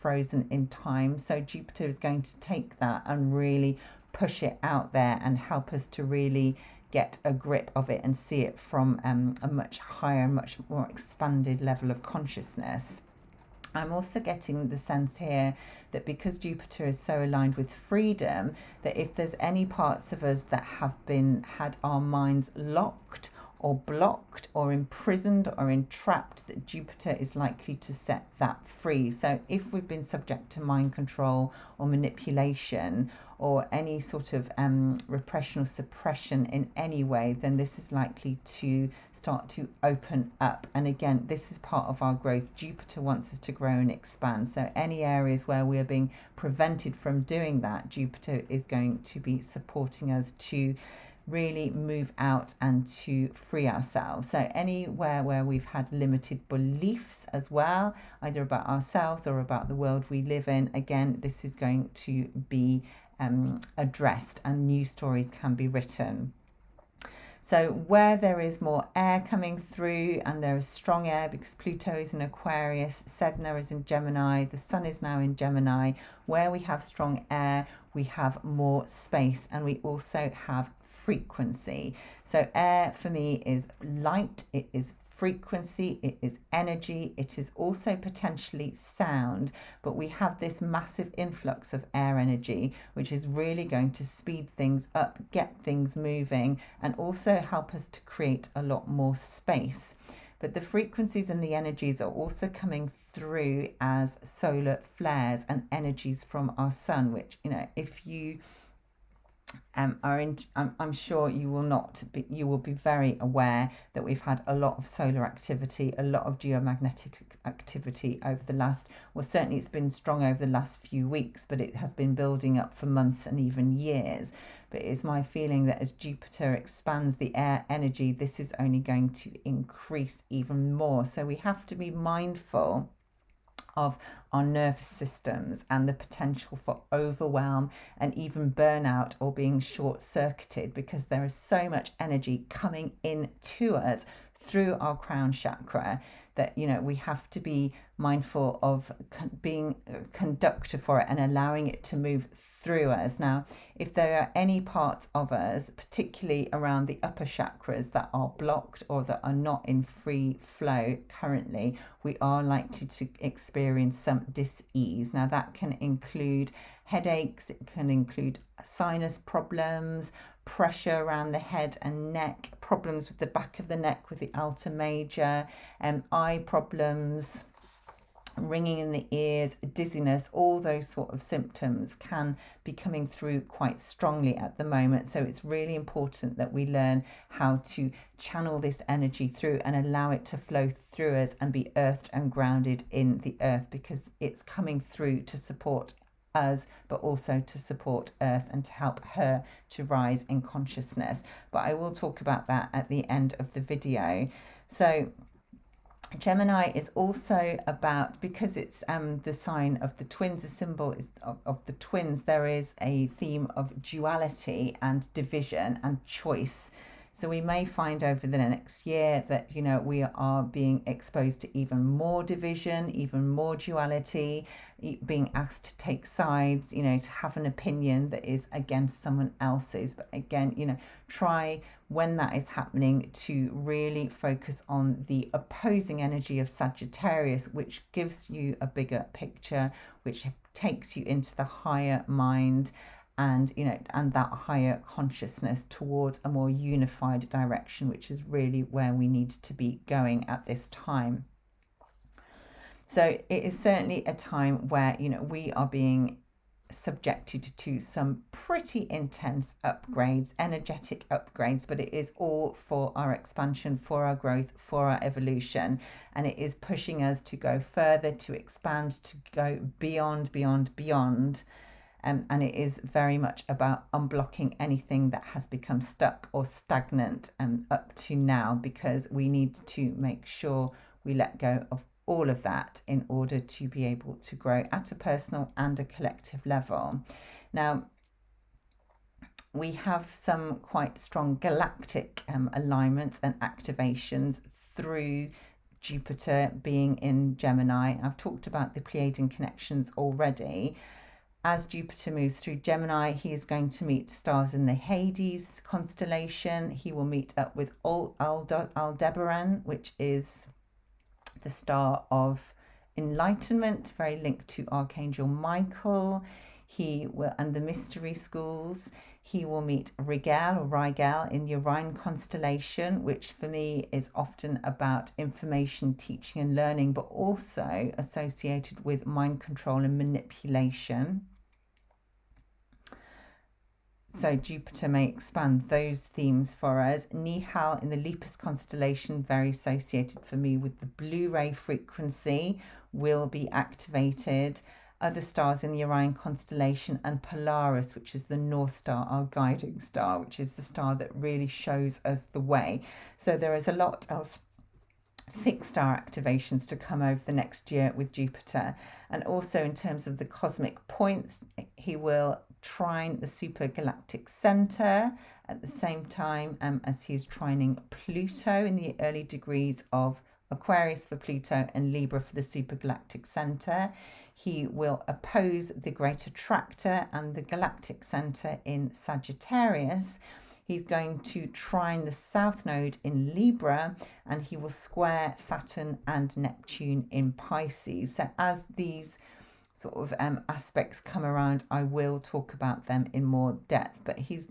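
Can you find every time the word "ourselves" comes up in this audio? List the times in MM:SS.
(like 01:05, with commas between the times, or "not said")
00:53, 00:58.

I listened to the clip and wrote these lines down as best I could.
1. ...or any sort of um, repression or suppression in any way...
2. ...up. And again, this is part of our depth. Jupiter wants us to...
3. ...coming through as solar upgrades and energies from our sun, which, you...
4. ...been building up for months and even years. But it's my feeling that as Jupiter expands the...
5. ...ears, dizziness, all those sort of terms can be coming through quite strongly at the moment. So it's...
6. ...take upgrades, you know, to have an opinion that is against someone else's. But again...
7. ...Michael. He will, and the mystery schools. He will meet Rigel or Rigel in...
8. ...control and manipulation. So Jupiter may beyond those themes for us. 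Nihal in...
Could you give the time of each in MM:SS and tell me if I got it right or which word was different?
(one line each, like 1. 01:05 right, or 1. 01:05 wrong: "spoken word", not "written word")
1. 00:33 right
2. 00:40 wrong: "growth", not "depth"
3. 01:42 wrong: "flares", not "upgrades"
4. 02:01 right
5. 02:59 wrong: "symptoms", not "terms"
6. 03:45 wrong: "sides", not "upgrades"
7. 05:15 right
8. 05:29 wrong: "expand", not "beyond".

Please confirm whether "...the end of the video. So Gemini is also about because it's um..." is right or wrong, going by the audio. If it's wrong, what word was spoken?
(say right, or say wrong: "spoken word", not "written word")
right.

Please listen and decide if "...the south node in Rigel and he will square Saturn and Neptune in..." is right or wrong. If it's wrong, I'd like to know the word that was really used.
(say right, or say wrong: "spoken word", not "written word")
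wrong: "Libra", not "Rigel".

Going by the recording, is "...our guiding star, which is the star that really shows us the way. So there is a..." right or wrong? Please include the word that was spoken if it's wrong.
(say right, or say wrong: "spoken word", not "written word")
right.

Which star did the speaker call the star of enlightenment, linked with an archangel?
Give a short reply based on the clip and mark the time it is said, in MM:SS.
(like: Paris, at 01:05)
Aldebaran, at 05:07.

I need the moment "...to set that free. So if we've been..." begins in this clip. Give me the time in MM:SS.
00:27.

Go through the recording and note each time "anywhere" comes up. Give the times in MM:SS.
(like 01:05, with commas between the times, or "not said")
00:54.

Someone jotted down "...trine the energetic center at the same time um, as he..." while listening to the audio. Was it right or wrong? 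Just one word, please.
wrong.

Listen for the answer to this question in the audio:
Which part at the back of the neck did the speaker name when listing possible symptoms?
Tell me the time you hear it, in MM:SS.
02:54.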